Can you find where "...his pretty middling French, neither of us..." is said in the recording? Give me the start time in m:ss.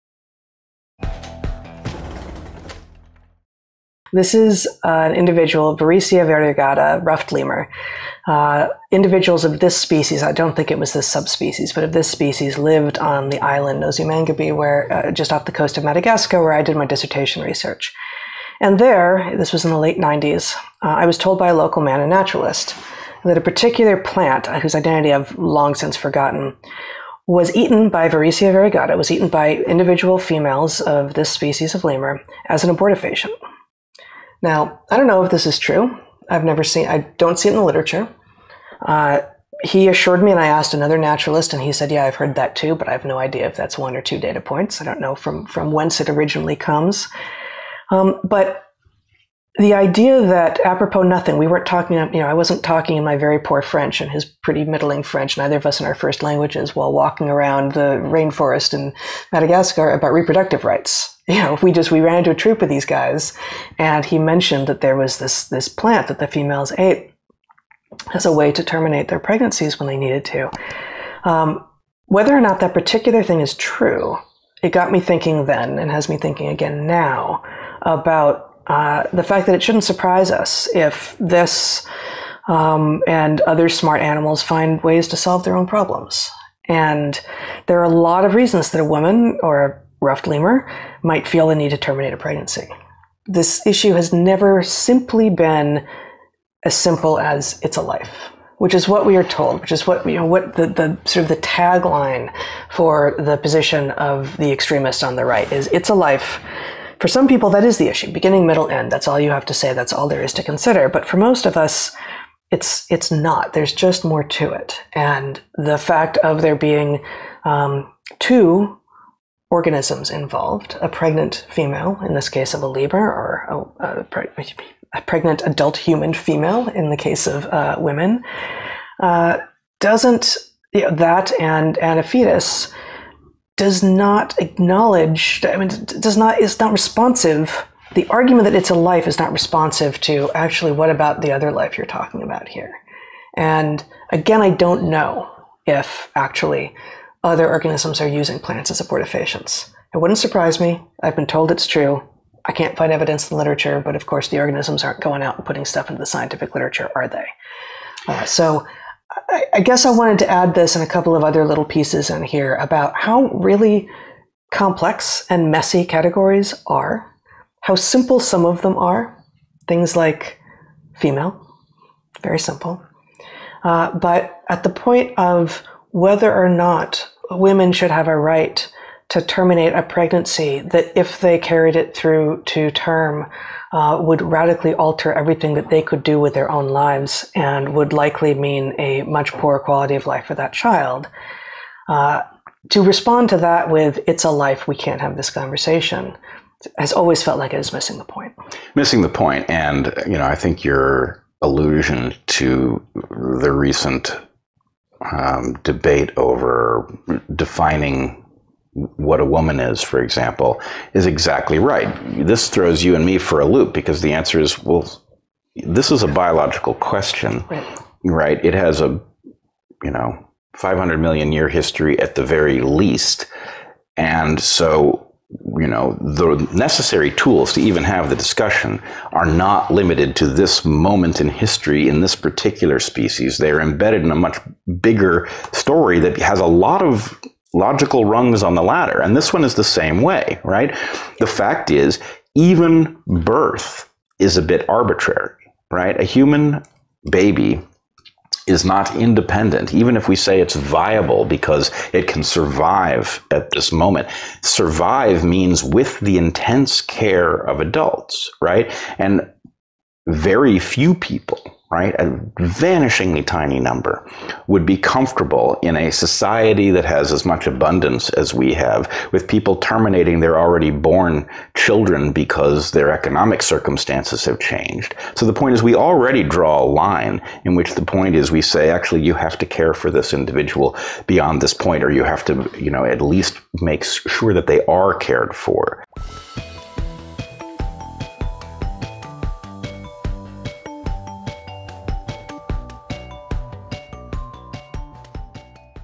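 0:54.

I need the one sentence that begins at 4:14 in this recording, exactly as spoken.
Survive means with the intense care of adults, right?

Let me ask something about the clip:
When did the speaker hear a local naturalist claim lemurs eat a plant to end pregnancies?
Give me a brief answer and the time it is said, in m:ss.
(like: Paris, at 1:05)
late 90s, at 0:19.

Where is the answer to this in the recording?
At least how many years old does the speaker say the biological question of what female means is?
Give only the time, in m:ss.
3:40.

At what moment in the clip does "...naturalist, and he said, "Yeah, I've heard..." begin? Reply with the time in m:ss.
0:40.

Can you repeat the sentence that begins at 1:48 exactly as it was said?
That's all you have to say, that's all there is to consider.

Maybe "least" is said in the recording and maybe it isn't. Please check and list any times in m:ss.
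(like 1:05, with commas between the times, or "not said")
3:42, 4:43.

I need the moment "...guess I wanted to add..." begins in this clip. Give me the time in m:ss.
2:39.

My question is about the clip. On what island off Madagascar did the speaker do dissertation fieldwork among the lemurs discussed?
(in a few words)
Mangabe.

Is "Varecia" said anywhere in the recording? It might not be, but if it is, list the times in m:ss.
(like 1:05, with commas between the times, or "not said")
0:05, 0:28.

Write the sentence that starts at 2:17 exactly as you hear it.
The argument that it's a life is not responsive to actually what about the other life you're talking about here.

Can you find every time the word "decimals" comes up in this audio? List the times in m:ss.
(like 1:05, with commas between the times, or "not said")
not said.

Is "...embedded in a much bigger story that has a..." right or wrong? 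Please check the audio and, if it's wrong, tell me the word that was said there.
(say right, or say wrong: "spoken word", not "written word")
right.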